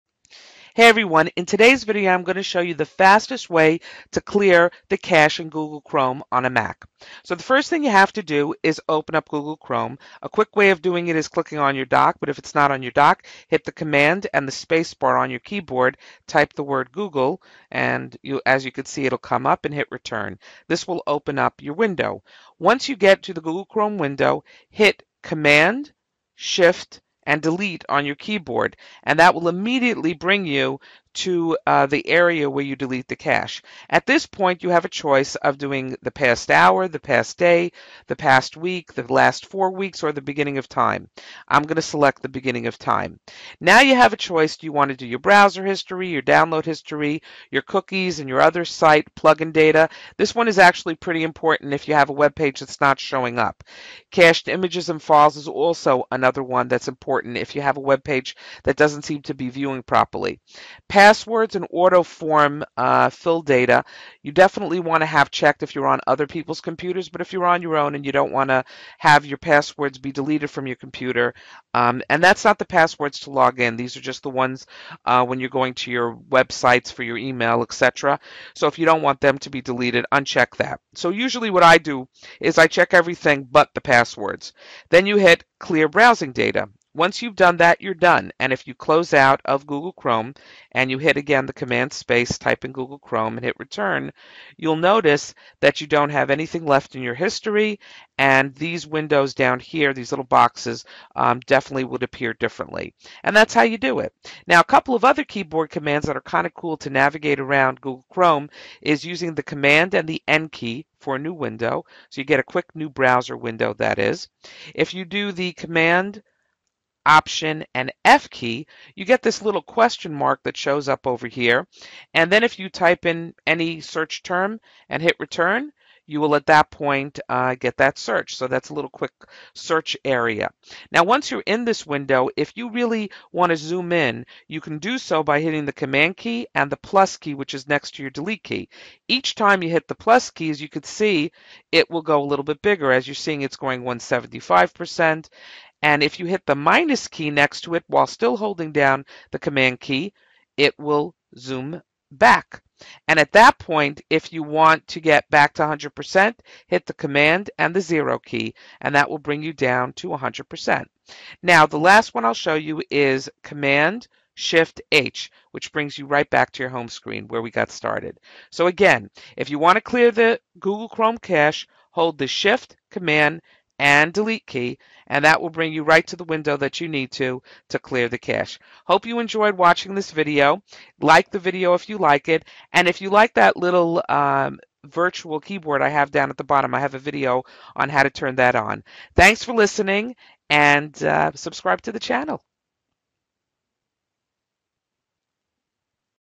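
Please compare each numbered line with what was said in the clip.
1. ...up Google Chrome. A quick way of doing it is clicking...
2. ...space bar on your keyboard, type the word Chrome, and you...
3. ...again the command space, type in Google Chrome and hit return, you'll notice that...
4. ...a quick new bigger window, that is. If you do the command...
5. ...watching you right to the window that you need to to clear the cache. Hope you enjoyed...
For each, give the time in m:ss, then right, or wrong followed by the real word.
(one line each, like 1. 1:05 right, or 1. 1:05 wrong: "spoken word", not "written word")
1. 0:09 right
2. 0:14 wrong: "Google", not "Chrome"
3. 1:31 right
4. 1:52 wrong: "browser", not "bigger"
5. 2:55 wrong: "bring", not "watching".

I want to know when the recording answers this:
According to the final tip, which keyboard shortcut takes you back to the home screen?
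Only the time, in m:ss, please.
2:43.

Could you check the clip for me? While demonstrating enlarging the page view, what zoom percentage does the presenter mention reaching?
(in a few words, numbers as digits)
175%.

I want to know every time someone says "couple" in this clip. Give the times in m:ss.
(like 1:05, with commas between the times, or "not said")
1:44.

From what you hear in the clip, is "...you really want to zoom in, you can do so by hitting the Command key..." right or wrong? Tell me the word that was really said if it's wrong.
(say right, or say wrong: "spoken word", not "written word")
right.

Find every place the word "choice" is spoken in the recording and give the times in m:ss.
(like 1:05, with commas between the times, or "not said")
0:34, 0:44.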